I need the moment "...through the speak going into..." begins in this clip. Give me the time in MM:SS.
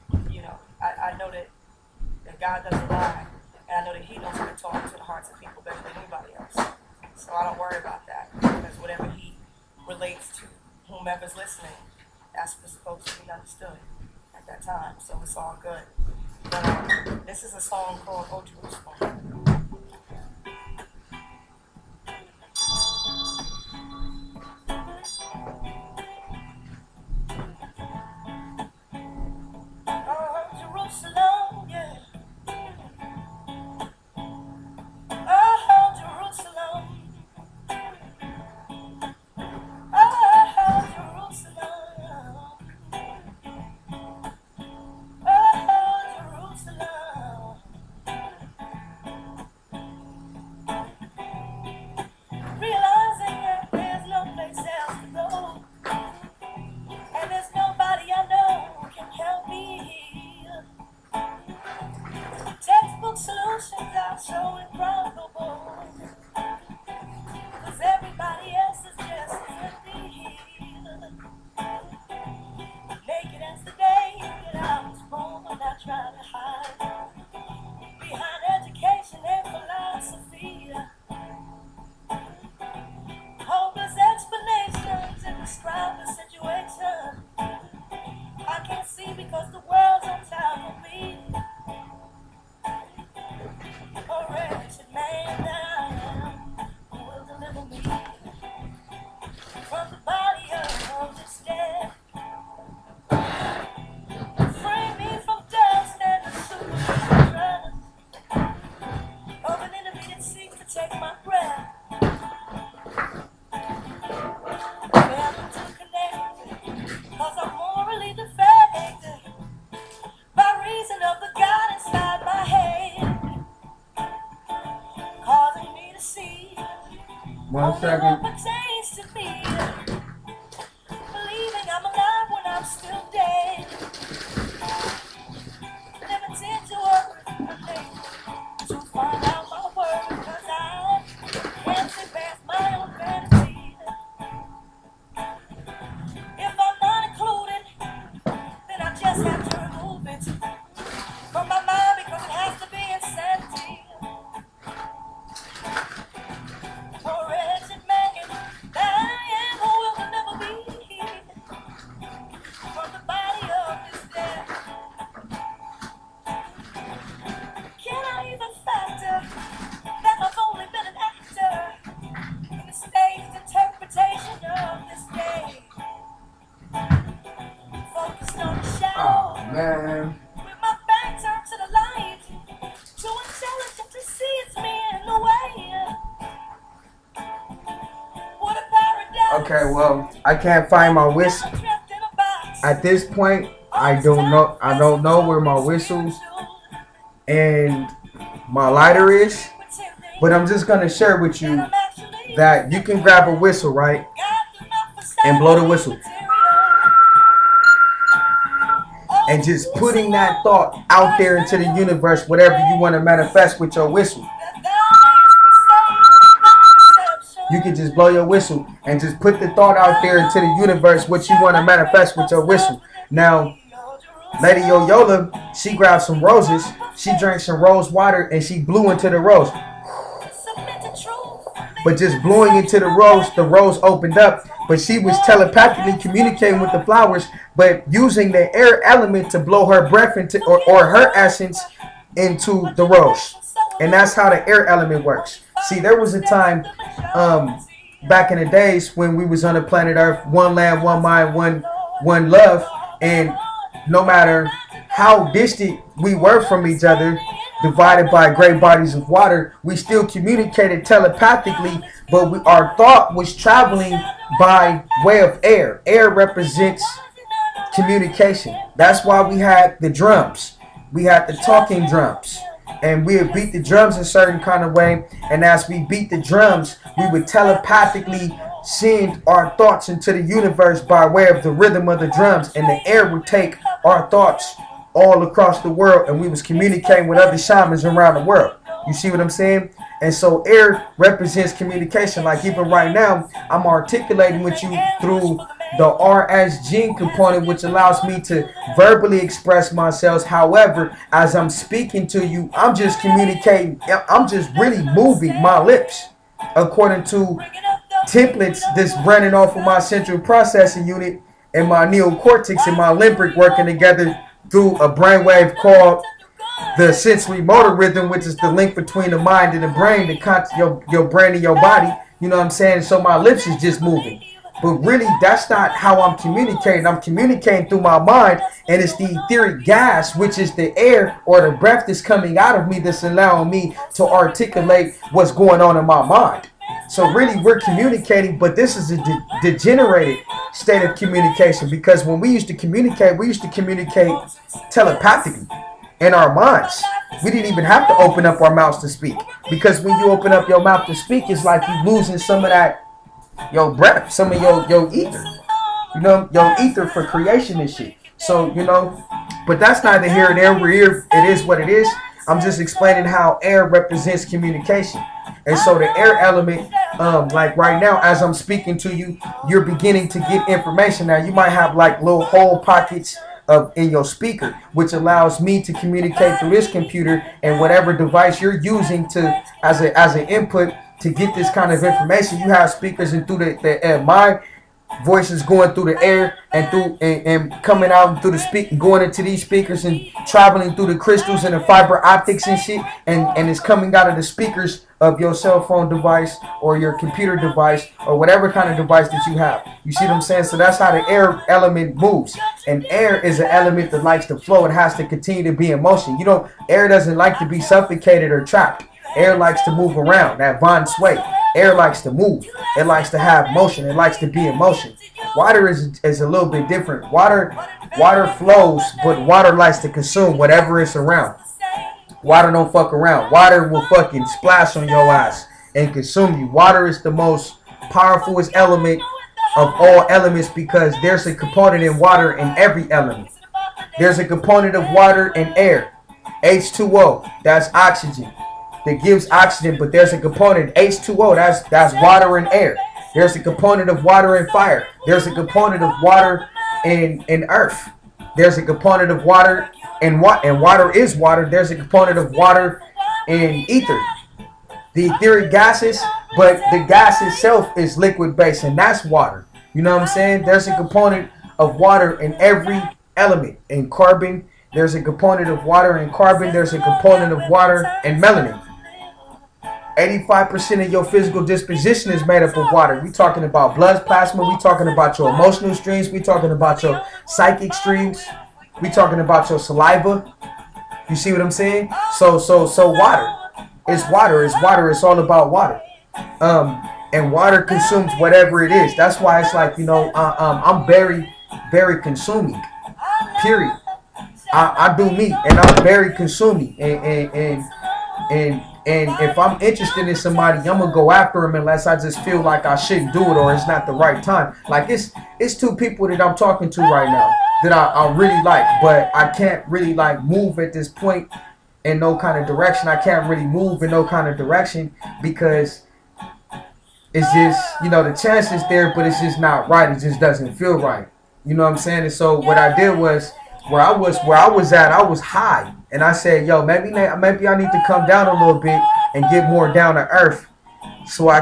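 06:28.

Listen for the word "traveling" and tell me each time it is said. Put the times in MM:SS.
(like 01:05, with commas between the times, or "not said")
04:23, 06:30.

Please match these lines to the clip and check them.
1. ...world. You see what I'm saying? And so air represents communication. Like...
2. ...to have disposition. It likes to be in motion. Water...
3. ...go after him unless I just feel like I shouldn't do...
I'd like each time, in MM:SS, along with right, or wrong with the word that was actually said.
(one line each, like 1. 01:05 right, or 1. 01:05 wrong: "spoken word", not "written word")
1. 04:48 right
2. 06:53 wrong: "motion", not "disposition"
3. 08:20 right.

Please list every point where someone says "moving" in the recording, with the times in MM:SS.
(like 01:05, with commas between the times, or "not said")
05:04, 05:23.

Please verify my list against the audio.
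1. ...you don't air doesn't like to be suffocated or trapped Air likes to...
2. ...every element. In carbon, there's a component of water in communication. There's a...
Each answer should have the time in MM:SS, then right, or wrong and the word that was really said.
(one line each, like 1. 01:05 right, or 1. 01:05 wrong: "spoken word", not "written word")
1. 06:46 right
2. 07:42 wrong: "carbon", not "communication".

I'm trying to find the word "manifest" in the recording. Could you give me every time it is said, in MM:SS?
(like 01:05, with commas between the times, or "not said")
03:32, 03:41.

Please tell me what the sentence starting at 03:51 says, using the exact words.
But just blowing into the rose, the rose opened up.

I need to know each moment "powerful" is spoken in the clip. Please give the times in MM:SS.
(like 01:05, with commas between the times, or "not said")
07:07.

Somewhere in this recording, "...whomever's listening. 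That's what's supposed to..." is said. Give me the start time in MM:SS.
00:10.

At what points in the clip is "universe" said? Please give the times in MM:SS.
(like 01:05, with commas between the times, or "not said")
03:31, 03:40, 04:40.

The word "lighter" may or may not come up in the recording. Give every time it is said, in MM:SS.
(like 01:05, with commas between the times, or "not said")
03:18.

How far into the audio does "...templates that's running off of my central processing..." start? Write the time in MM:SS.
05:08.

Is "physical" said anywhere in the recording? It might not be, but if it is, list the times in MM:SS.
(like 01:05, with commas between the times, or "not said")
07:51.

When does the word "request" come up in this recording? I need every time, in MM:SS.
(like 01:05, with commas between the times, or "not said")
not said.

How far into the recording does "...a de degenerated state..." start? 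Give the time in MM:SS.
05:38.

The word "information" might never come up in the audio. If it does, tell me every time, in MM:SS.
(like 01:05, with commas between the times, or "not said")
06:10, 06:21.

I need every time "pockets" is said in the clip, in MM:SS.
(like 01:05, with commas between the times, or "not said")
06:12.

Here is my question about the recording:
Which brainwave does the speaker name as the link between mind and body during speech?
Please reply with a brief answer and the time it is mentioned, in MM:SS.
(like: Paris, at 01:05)
sensory motor rhythm, at 05:16.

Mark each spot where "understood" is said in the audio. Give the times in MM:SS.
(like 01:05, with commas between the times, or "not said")
00:13.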